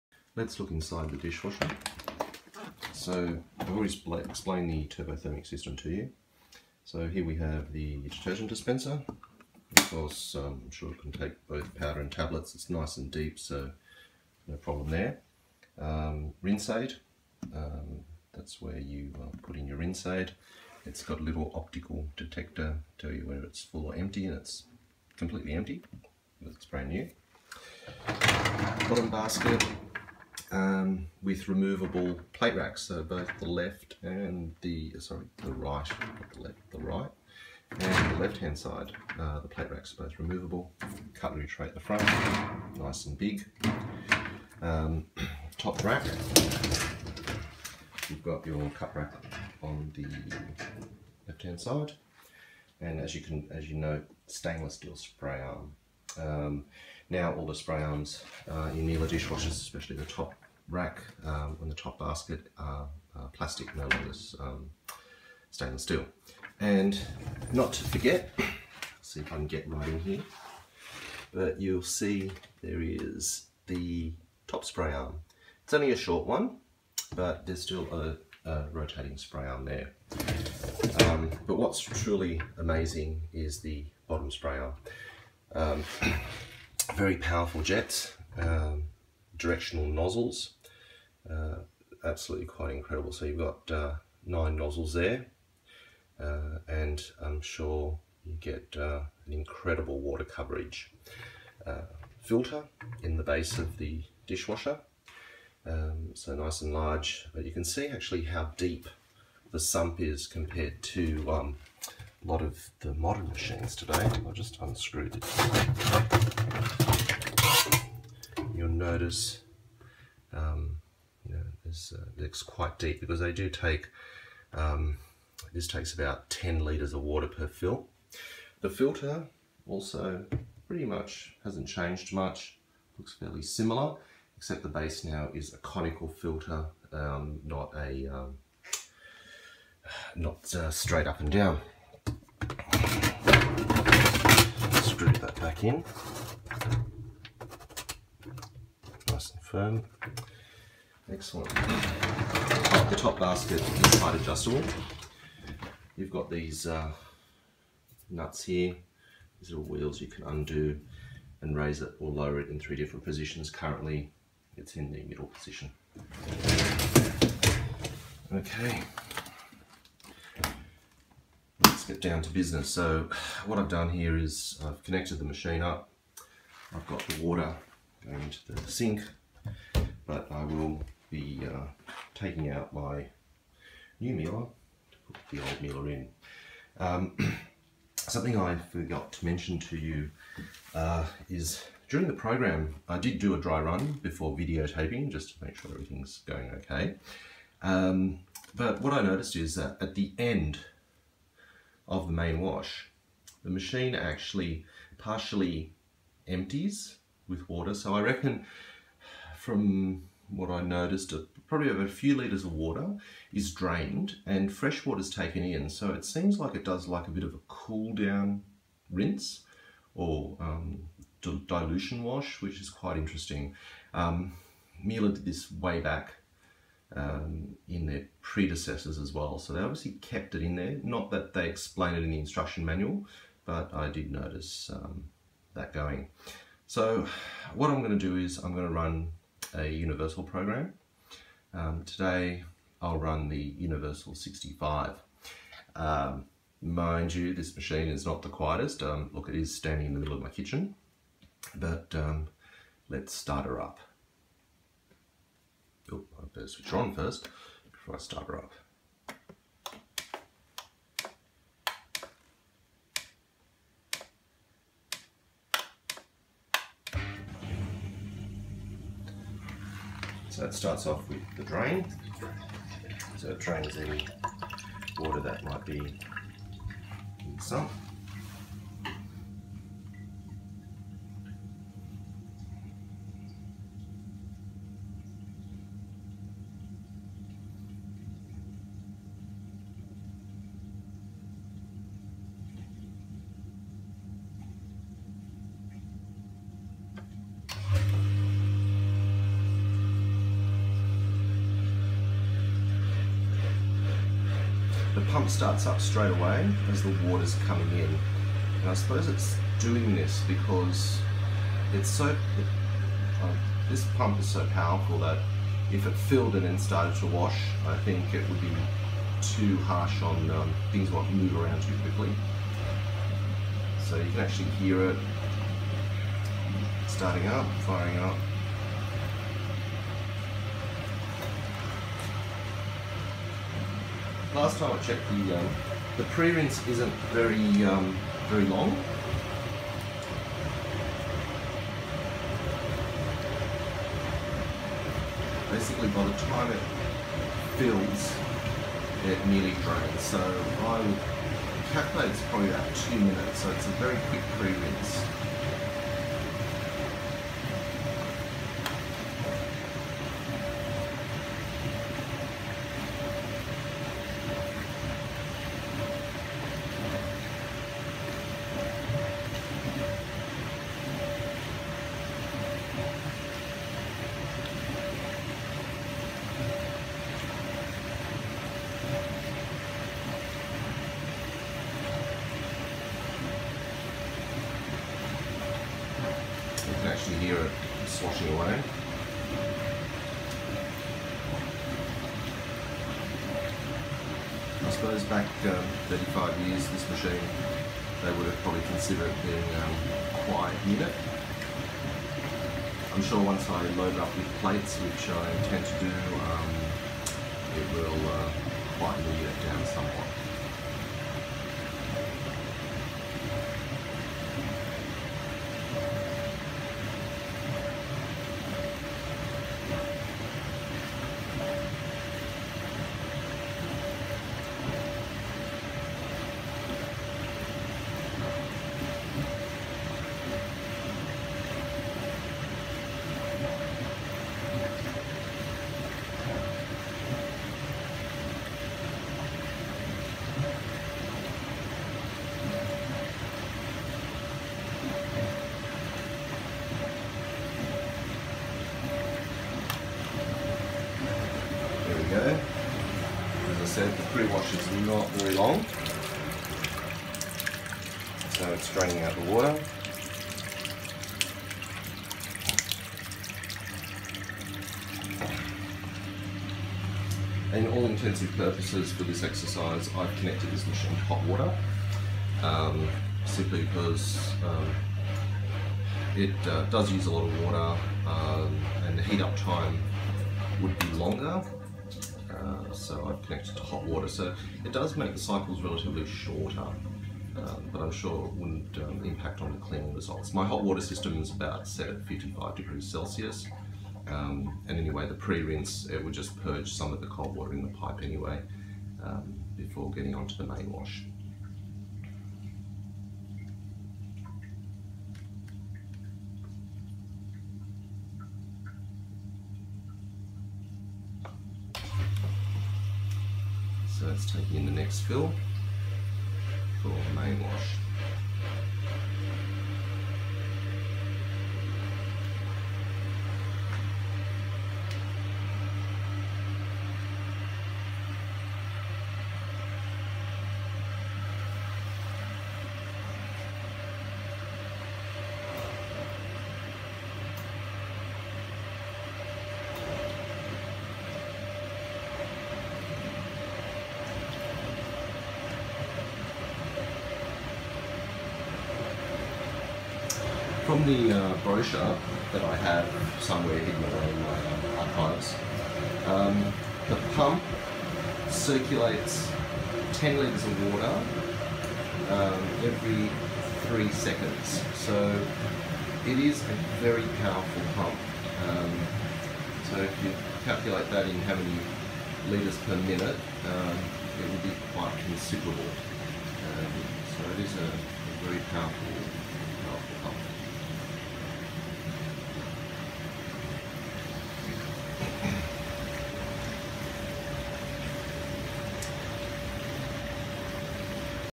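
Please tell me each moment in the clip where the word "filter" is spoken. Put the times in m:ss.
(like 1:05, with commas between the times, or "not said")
1:42, 2:08, 2:16.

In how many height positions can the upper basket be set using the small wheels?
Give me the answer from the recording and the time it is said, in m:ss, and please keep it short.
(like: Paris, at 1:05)
3, at 2:42.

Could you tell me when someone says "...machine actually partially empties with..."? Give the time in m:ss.
3:23.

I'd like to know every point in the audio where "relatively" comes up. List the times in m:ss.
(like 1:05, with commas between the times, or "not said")
8:05.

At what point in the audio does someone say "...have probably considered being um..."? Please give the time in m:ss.
6:38.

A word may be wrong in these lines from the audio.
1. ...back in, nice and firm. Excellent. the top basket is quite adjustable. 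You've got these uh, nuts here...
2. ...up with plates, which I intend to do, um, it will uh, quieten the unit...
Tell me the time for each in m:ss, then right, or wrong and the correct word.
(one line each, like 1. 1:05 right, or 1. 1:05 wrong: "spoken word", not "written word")
1. 2:25 right
2. 6:43 right.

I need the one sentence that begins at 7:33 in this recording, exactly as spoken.
said, the pre-wash is not very long.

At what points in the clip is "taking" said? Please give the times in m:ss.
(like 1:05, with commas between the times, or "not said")
3:02, 8:34.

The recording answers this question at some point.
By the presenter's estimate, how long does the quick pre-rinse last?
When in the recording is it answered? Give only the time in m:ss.
5:52.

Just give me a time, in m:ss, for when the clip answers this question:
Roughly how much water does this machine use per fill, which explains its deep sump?
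2:06.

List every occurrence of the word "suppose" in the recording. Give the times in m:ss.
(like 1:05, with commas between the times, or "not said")
5:08, 6:34.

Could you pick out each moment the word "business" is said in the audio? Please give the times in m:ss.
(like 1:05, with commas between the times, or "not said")
2:52.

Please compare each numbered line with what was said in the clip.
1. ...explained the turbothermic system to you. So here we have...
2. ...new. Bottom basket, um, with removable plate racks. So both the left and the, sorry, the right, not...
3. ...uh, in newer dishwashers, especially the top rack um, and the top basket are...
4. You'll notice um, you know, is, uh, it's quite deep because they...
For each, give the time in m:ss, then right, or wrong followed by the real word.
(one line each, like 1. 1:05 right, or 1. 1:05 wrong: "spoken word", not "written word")
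1. 0:04 right
2. 0:26 right
3. 0:58 right
4. 1:58 right.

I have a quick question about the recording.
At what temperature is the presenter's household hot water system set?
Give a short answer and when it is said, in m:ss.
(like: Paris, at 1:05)
55 degrees Celsius, at 8:12.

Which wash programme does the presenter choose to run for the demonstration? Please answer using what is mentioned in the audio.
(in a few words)
Universal 65.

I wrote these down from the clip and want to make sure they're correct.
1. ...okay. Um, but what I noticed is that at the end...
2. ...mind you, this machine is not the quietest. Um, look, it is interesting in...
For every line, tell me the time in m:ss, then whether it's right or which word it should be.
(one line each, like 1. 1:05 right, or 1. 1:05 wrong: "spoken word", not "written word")
1. 3:16 right
2. 4:06 wrong: "standing", not "interesting".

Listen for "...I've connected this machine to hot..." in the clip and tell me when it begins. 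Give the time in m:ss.
7:49.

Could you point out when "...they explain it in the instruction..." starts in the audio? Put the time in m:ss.
3:51.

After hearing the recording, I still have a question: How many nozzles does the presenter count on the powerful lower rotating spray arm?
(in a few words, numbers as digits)
9.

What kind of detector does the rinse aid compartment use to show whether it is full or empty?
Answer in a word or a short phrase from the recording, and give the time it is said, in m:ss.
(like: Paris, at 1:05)
optical, at 0:21.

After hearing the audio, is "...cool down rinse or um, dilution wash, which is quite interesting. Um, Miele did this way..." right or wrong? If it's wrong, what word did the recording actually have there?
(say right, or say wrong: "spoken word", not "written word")
right.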